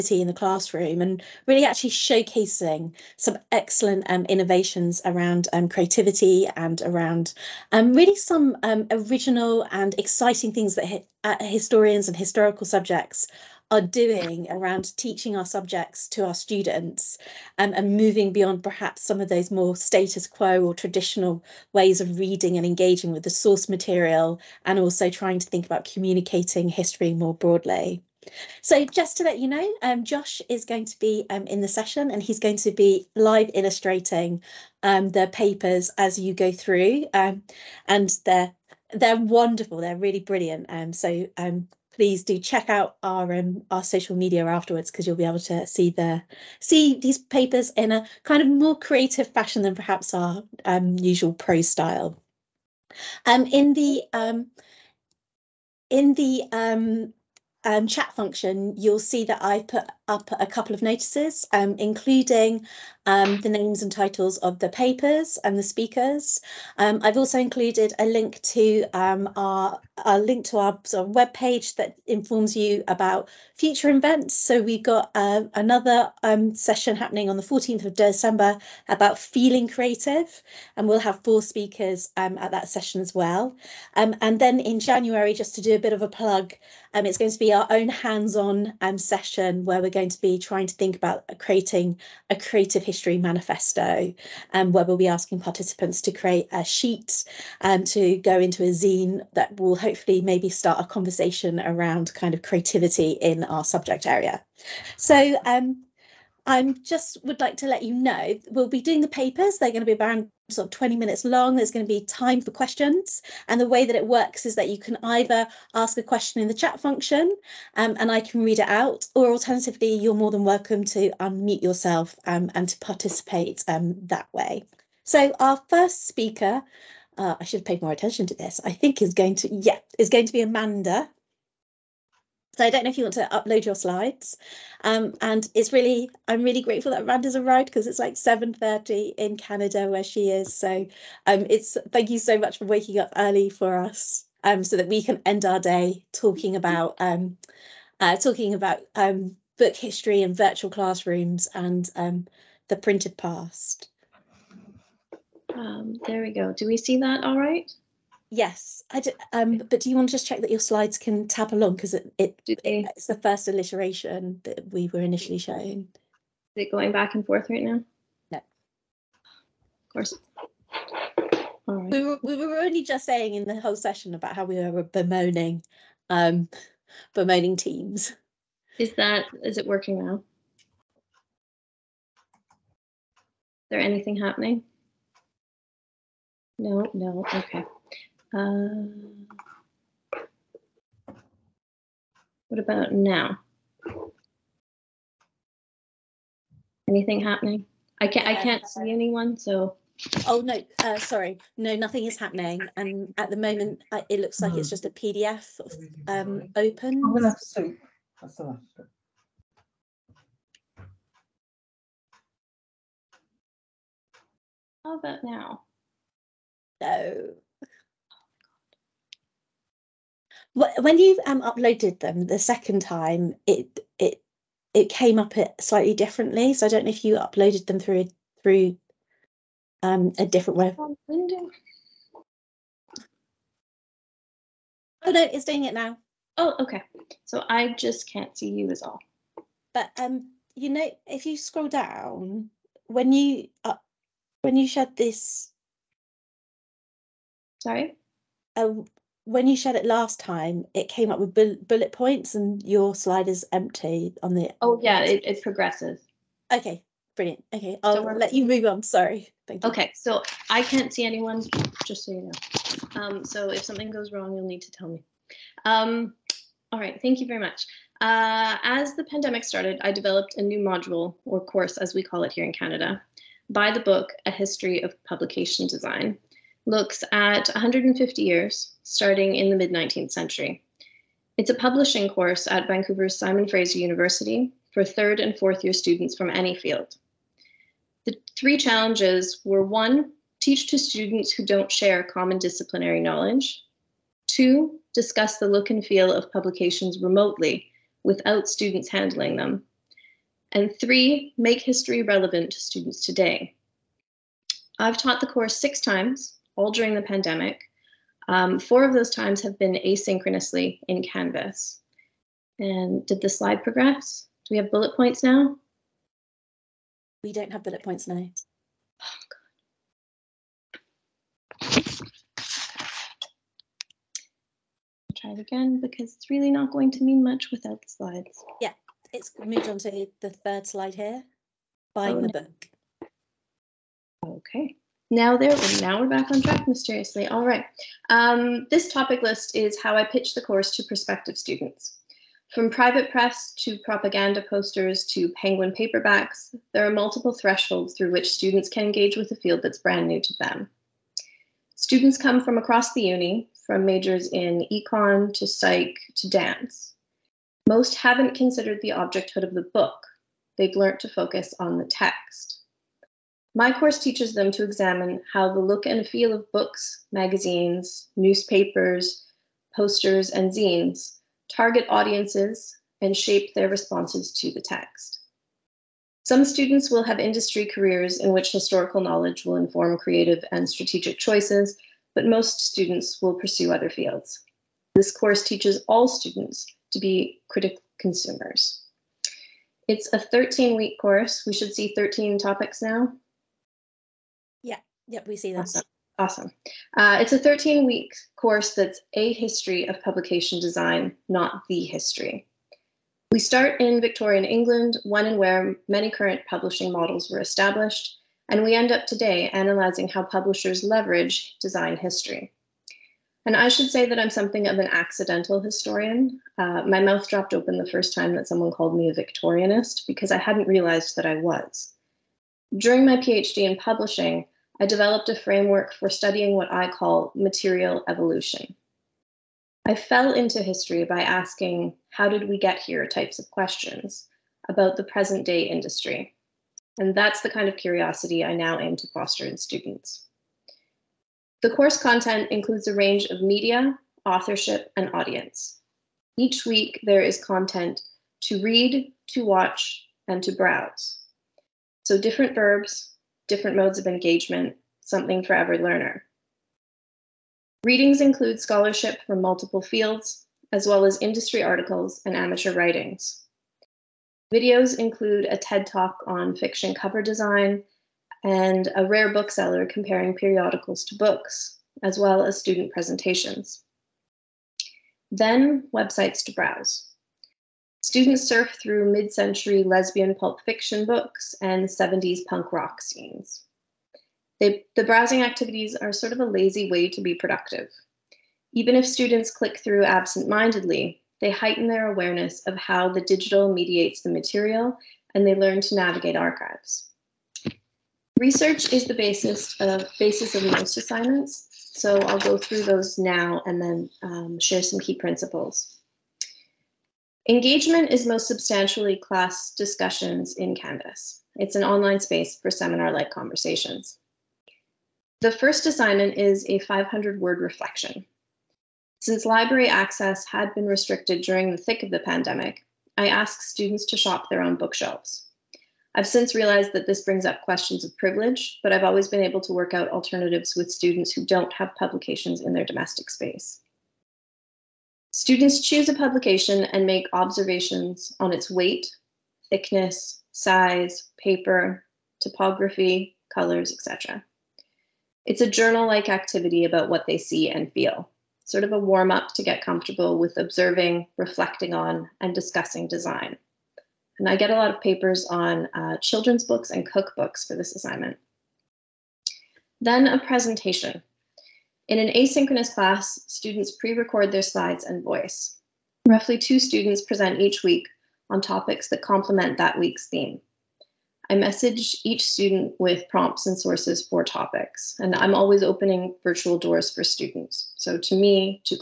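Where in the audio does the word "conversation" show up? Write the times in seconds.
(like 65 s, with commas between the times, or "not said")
100 s, 513 s.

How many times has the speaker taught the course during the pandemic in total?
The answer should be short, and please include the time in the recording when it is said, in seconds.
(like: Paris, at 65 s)
Six, at 305 s.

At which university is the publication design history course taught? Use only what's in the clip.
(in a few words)
Simon Fraser University.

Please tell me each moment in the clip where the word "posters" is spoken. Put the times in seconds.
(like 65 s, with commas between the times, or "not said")
344 s, 369 s.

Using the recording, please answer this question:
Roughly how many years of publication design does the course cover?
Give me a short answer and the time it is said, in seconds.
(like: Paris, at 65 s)
150 years, at 277 s.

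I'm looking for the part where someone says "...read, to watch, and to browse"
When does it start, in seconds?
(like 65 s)
448 s.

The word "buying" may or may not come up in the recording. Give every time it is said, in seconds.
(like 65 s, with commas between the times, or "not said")
331 s.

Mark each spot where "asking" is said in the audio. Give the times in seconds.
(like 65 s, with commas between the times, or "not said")
95 s, 431 s.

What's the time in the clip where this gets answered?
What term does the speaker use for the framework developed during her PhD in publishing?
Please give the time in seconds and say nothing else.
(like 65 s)
427 s.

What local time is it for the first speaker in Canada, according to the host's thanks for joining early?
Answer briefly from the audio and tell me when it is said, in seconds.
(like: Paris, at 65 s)
7.30, at 138 s.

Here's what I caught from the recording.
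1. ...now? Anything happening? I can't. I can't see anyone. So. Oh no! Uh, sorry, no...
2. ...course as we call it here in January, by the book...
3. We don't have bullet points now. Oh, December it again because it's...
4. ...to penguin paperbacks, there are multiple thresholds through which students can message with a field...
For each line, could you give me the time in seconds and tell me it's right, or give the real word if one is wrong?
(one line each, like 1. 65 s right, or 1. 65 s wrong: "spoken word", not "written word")
1. 192 s right
2. 271 s wrong: "Canada", not "January"
3. 317 s wrong: "Try", not "December"
4. 345 s wrong: "engage", not "message".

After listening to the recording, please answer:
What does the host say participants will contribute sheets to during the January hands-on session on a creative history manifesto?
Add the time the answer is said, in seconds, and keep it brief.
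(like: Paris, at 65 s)
A zine, at 98 s.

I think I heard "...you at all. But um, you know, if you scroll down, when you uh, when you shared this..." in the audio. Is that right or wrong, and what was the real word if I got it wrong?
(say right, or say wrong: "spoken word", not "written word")
right.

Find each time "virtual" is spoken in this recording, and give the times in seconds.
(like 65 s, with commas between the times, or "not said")
150 s, 576 s.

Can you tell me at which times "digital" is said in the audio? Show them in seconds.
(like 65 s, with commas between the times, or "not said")
493 s.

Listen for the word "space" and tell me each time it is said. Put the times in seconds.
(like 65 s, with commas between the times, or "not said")
512 s, 533 s.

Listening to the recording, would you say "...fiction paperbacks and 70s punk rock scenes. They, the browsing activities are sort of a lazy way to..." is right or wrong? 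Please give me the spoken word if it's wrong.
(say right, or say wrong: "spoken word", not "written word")
wrong: "books", not "paperbacks".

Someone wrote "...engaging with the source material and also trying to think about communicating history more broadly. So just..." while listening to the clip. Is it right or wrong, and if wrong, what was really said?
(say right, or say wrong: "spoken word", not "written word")
right.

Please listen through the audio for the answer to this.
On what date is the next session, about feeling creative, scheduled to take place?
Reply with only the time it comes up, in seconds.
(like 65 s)
77 s.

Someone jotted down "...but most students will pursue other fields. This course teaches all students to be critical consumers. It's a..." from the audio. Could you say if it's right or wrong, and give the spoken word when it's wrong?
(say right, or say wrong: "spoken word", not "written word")
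right.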